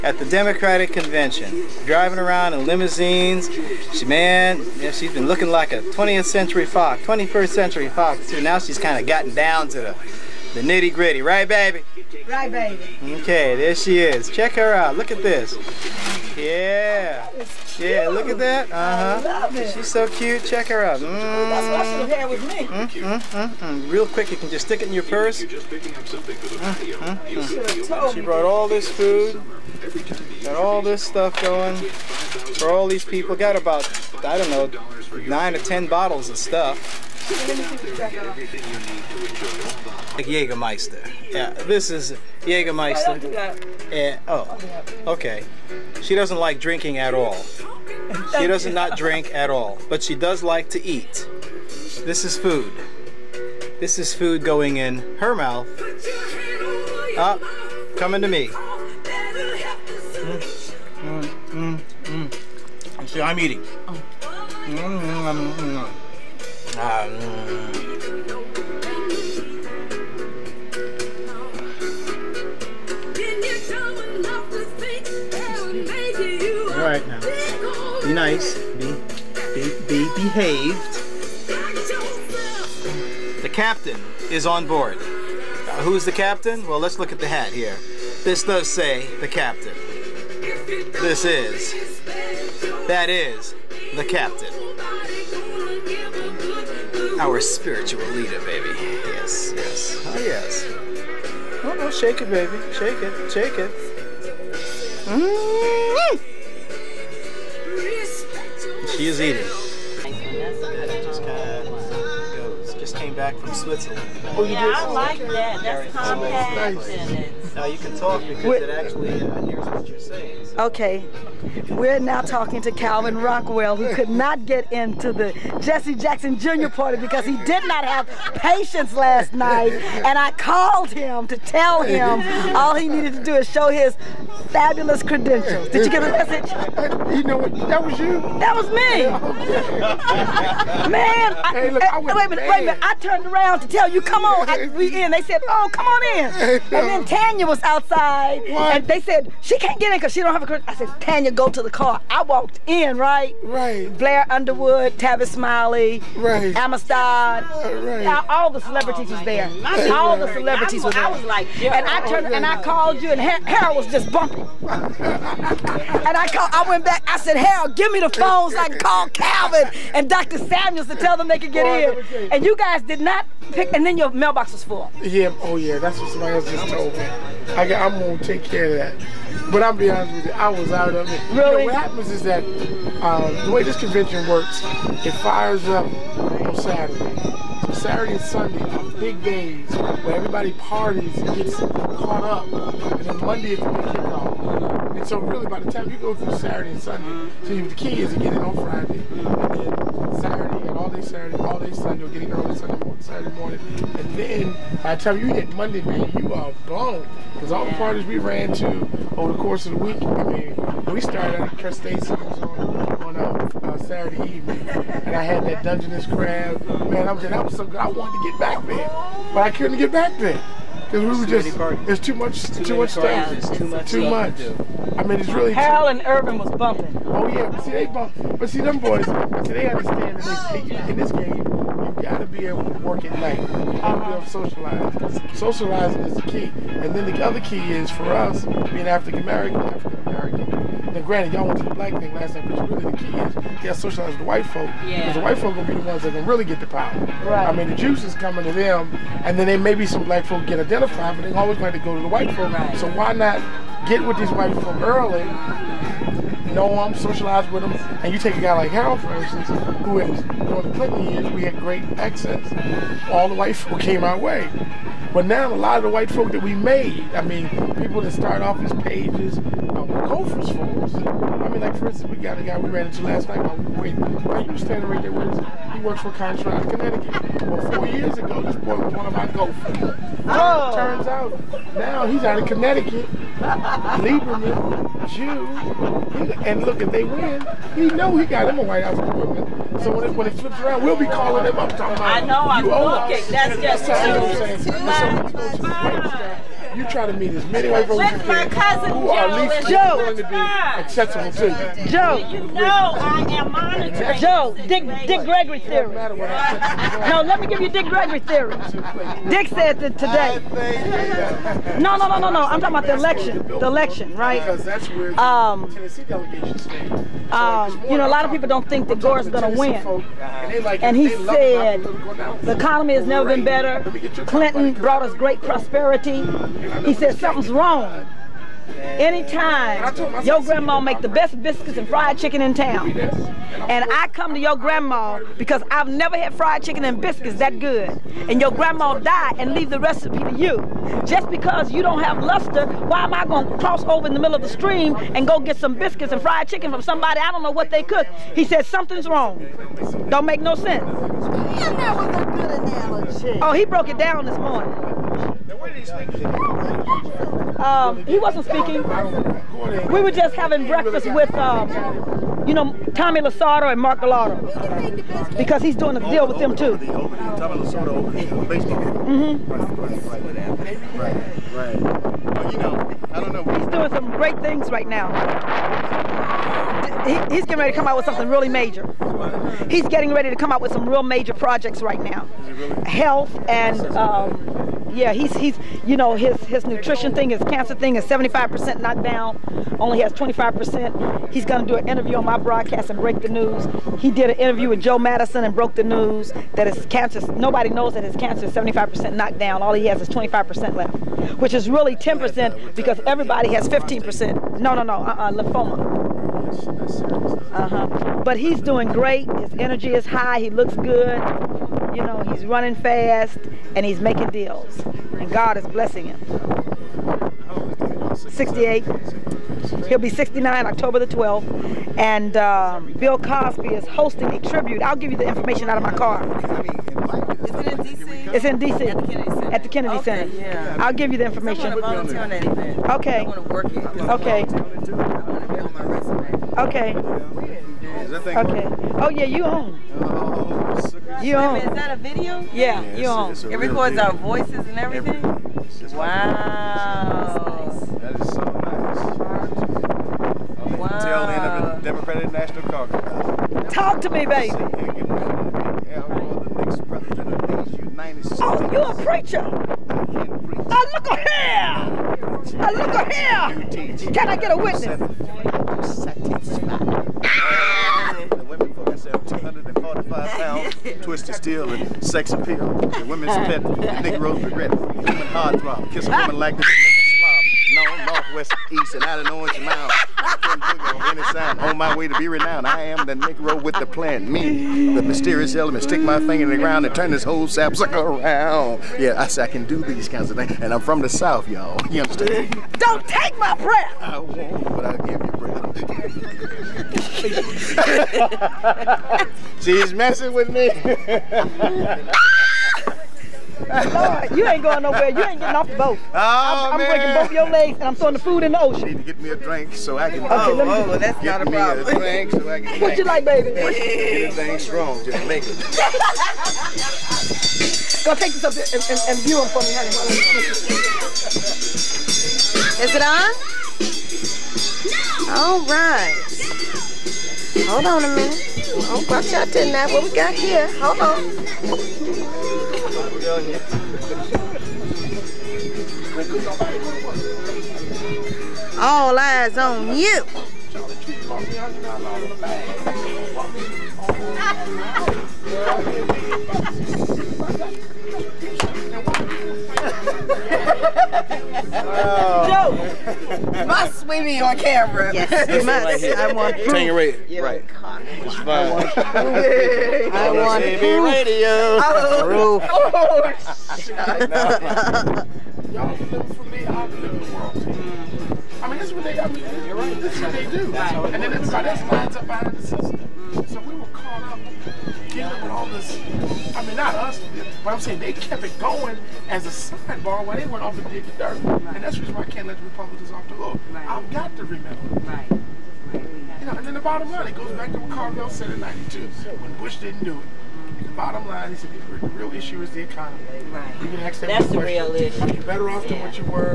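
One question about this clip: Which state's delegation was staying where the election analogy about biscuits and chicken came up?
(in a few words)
Tennessee.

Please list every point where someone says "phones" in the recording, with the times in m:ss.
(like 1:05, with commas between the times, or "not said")
2:48.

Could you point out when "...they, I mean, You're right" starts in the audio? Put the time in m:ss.
9:29.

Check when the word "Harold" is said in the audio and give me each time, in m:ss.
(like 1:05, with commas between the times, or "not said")
2:43, 2:47, 4:18.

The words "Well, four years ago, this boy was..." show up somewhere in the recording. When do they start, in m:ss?
4:37.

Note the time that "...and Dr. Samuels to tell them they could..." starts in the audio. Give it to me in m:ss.
2:49.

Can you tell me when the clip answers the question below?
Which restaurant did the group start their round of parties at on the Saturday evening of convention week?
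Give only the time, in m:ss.
3:31.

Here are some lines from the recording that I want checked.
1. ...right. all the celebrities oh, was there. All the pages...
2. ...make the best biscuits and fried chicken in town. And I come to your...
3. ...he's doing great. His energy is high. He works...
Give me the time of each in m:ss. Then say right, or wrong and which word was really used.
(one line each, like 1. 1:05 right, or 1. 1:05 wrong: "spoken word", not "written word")
1. 2:37 wrong: "celebrities", not "pages"
2. 5:30 right
3. 6:48 wrong: "looks", not "works".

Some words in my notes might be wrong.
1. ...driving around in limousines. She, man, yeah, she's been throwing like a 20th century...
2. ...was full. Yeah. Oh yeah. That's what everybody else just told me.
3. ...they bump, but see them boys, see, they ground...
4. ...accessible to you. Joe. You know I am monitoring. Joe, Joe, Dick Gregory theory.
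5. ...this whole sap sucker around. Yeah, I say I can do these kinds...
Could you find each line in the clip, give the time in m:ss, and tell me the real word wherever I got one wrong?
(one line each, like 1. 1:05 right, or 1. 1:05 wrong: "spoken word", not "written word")
1. 0:01 wrong: "looking", not "throwing"
2. 2:54 wrong: "somebody", not "everybody"
3. 3:47 wrong: "understand", not "ground"
4. 5:00 wrong: "Dick", not "Joe"
5. 8:07 right.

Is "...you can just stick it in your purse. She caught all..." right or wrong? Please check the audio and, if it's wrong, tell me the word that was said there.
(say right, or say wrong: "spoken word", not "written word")
wrong: "brought", not "caught".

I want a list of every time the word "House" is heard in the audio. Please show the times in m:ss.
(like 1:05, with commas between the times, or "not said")
4:48.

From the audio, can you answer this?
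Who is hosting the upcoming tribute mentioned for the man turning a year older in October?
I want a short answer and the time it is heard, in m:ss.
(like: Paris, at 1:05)
Bill Cosby, at 7:02.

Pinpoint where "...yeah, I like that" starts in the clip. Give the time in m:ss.
1:54.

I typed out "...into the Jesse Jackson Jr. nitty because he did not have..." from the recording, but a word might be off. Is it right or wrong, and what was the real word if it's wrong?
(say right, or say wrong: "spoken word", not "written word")
wrong: "party", not "nitty".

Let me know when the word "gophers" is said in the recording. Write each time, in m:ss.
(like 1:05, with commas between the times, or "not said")
4:30, 4:39.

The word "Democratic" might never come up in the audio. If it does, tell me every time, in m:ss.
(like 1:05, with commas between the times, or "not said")
0:00, 7:31.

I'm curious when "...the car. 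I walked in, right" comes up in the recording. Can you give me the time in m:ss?
2:31.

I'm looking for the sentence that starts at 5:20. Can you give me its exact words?
And he said, the economy has never been better.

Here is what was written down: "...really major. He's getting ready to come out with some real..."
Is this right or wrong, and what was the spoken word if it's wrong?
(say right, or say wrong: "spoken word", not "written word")
right.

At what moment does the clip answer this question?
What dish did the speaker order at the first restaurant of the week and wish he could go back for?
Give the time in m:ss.
3:35.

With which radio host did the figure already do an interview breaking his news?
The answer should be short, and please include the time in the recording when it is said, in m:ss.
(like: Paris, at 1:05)
Joe Madison, at 6:34.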